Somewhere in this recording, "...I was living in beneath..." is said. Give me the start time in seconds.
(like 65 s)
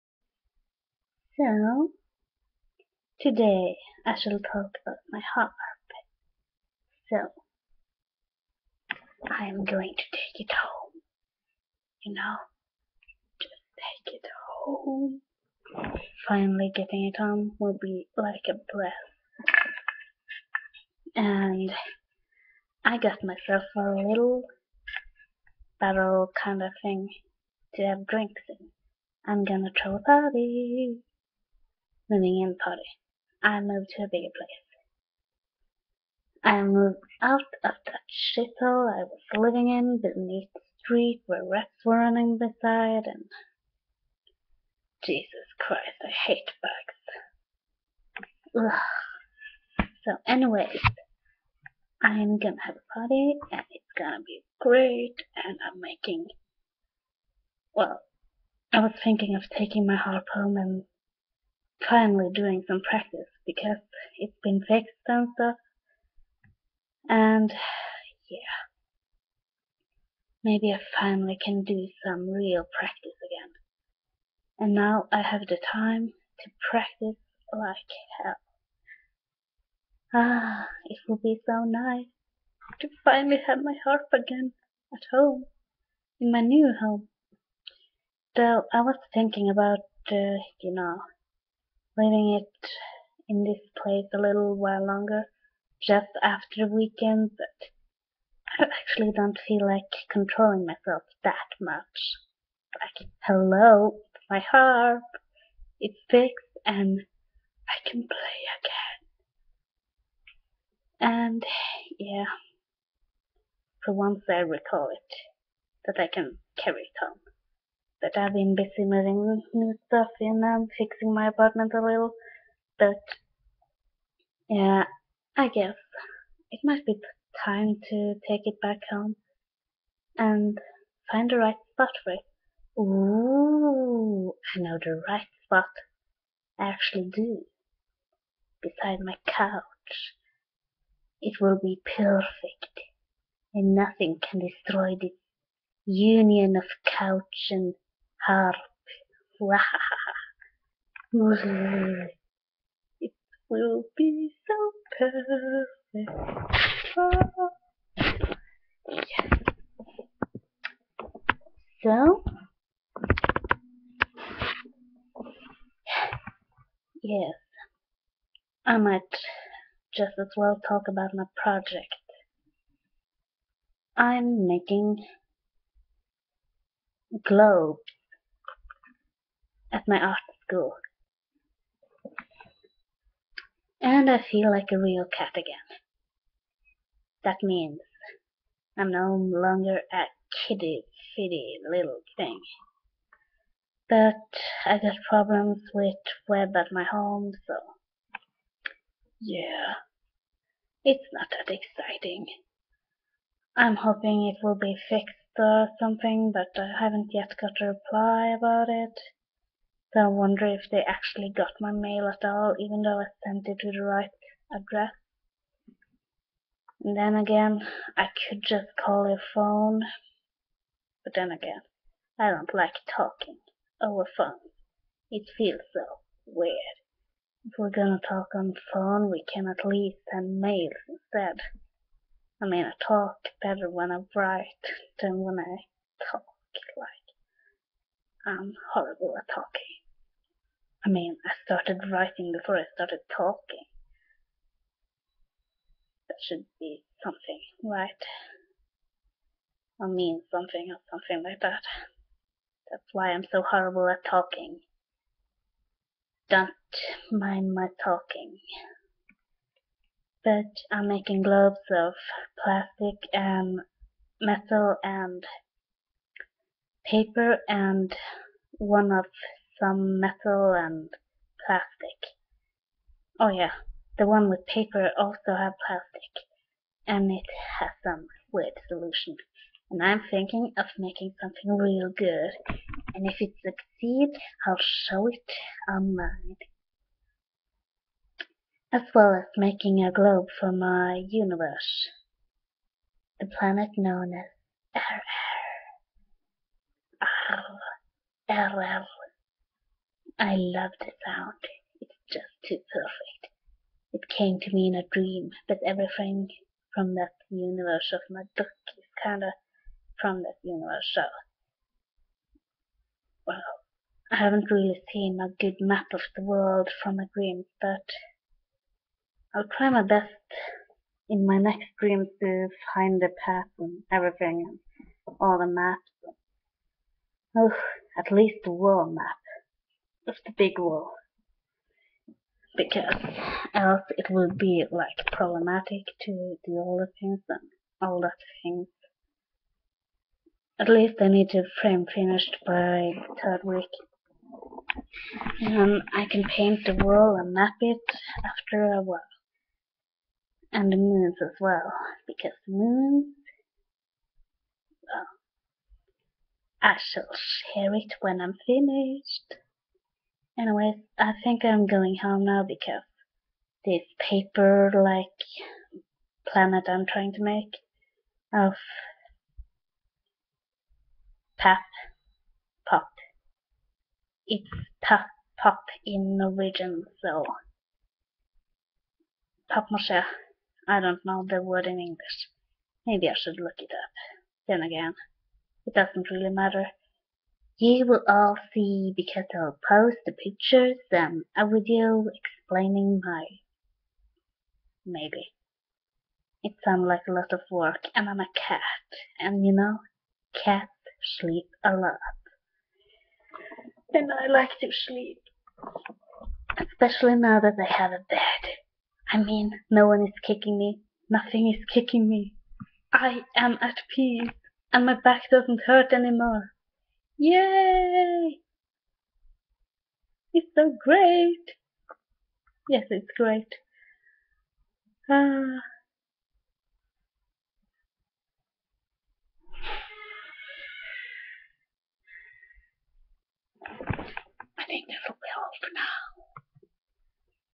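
38 s.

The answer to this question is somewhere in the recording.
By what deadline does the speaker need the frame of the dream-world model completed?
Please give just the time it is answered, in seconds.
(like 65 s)
343 s.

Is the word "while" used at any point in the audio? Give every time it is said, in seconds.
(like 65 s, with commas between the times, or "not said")
94 s, 348 s.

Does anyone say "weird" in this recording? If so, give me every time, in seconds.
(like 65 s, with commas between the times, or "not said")
226 s, 278 s.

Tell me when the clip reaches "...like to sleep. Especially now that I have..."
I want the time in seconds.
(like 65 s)
404 s.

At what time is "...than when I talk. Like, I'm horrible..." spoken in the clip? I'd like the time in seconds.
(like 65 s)
235 s.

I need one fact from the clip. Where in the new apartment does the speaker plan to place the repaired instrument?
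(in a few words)
Beside my couch.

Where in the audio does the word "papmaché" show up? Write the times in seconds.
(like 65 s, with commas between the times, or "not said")
379 s.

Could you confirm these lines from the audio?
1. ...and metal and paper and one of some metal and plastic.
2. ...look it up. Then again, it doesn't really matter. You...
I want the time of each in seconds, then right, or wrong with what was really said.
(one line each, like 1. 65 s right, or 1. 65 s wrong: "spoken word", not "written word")
1. 263 s right
2. 383 s right.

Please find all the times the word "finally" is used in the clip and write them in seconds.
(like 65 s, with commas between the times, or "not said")
16 s, 61 s, 70 s, 83 s.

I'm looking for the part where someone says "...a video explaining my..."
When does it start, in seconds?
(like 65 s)
391 s.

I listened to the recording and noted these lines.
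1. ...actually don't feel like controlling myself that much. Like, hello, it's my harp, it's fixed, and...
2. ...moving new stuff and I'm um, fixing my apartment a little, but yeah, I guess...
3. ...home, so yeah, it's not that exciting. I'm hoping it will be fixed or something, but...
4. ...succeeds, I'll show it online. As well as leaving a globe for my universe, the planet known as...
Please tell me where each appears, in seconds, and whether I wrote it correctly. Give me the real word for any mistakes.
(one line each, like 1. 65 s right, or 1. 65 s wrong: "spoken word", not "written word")
1. 98 s right
2. 118 s right
3. 196 s right
4. 283 s wrong: "making", not "leaving".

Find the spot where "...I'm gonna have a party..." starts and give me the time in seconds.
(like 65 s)
52 s.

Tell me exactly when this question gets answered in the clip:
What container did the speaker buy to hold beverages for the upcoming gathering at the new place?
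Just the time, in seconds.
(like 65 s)
25 s.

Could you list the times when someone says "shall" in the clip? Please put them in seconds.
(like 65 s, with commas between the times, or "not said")
4 s, 356 s.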